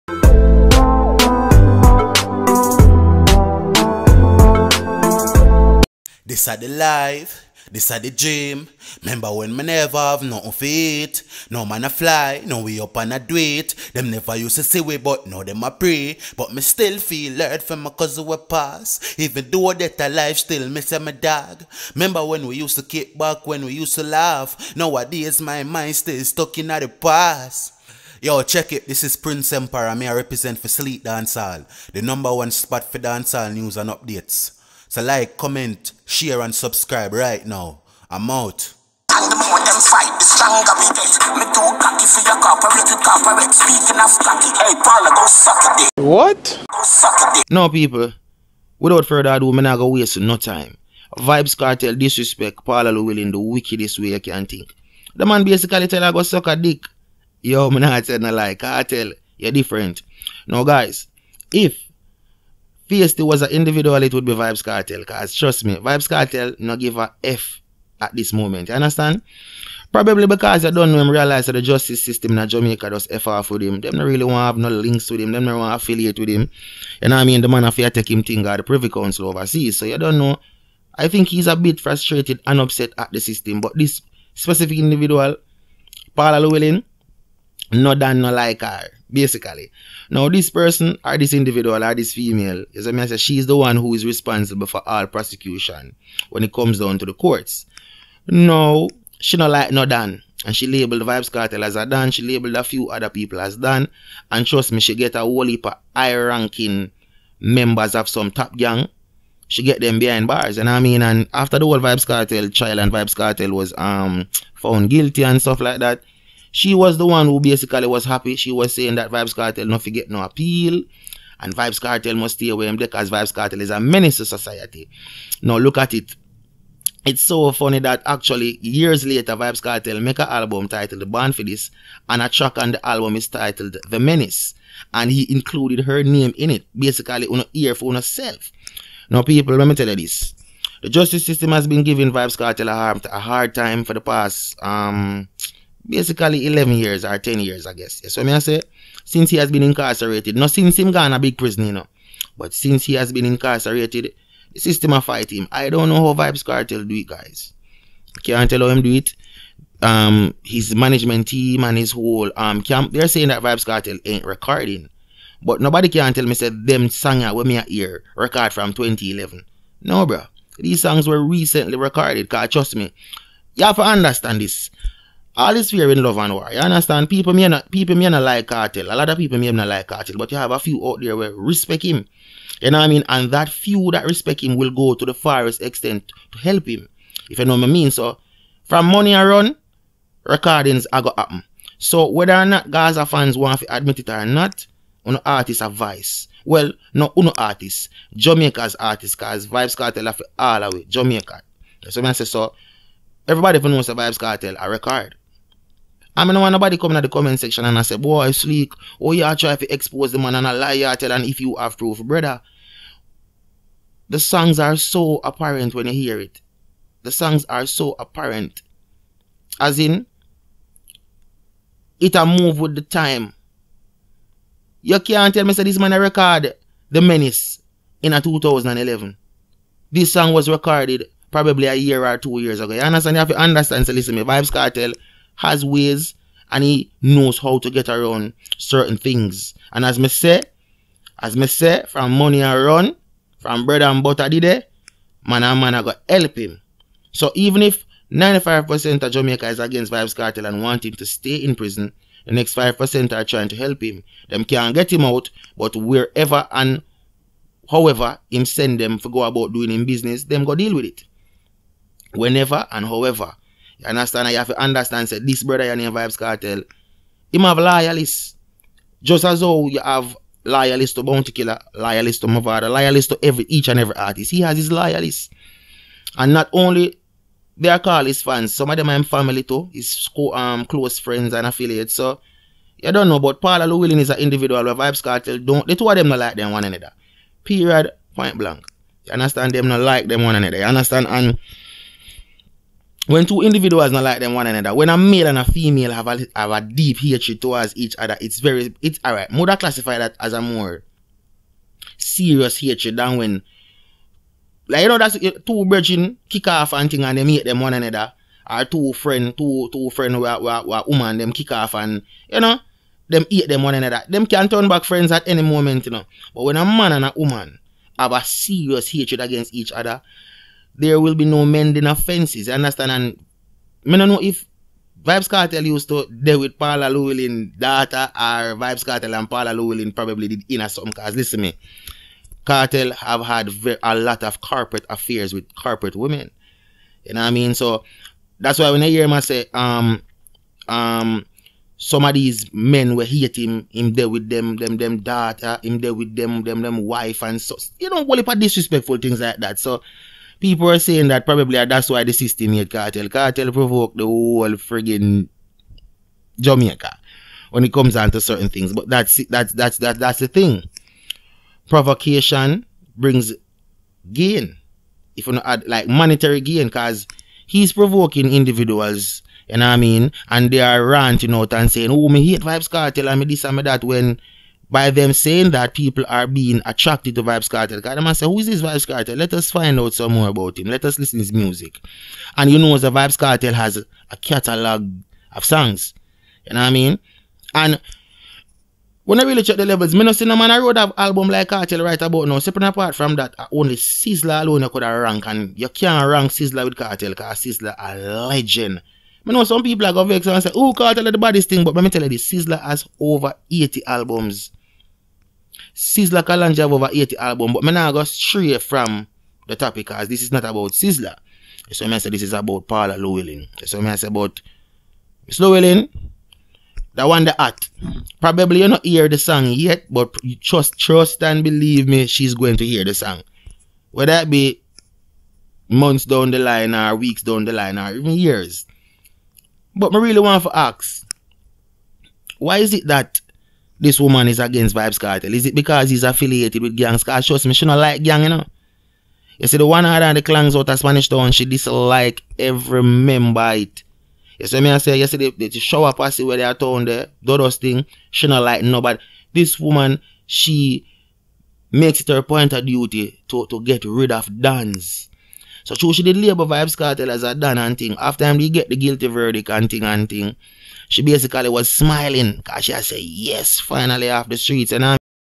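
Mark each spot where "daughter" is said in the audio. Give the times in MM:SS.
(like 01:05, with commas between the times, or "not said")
05:27, 05:44.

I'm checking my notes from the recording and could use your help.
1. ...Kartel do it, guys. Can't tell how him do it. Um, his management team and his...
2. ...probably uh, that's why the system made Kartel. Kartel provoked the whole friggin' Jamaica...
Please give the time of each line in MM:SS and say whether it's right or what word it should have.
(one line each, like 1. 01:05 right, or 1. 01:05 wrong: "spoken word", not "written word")
1. 02:36 right
2. 05:51 right.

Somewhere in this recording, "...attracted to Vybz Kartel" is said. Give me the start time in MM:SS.
06:16.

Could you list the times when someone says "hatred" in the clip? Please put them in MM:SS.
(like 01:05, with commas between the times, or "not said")
04:56, 05:02, 05:18.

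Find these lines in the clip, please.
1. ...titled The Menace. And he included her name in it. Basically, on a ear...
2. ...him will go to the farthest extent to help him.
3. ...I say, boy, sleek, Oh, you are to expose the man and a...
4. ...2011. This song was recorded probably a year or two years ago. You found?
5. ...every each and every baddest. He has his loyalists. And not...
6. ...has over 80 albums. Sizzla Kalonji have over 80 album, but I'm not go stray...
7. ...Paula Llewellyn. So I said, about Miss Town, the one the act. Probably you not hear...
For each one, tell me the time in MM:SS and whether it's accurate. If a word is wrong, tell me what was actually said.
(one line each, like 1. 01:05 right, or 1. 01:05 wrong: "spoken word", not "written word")
1. 02:13 right
2. 03:04 right
3. 03:27 right
4. 03:48 wrong: "understand", not "found"
5. 04:33 wrong: "artist", not "baddest"
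6. 06:42 right
7. 06:52 wrong: "Llewellyn", not "Town".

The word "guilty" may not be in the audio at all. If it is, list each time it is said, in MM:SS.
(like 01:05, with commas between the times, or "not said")
01:54, 07:38.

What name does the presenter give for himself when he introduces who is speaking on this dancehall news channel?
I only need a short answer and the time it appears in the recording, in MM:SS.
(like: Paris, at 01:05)
Prince Empire, at 00:29.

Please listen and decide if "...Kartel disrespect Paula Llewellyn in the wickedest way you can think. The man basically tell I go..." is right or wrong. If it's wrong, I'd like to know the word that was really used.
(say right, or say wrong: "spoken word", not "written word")
right.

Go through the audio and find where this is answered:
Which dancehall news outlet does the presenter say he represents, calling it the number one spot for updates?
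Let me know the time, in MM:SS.
00:30.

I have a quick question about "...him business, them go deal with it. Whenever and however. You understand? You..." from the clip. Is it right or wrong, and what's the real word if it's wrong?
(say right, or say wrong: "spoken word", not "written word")
right.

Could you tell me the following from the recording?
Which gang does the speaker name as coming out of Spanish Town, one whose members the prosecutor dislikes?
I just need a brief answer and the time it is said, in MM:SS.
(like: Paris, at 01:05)
One Order, at 07:19.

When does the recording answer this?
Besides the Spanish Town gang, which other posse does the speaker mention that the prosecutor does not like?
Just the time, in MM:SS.
07:25.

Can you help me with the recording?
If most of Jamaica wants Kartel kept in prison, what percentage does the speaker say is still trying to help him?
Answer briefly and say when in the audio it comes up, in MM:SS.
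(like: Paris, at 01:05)
5%, at 04:12.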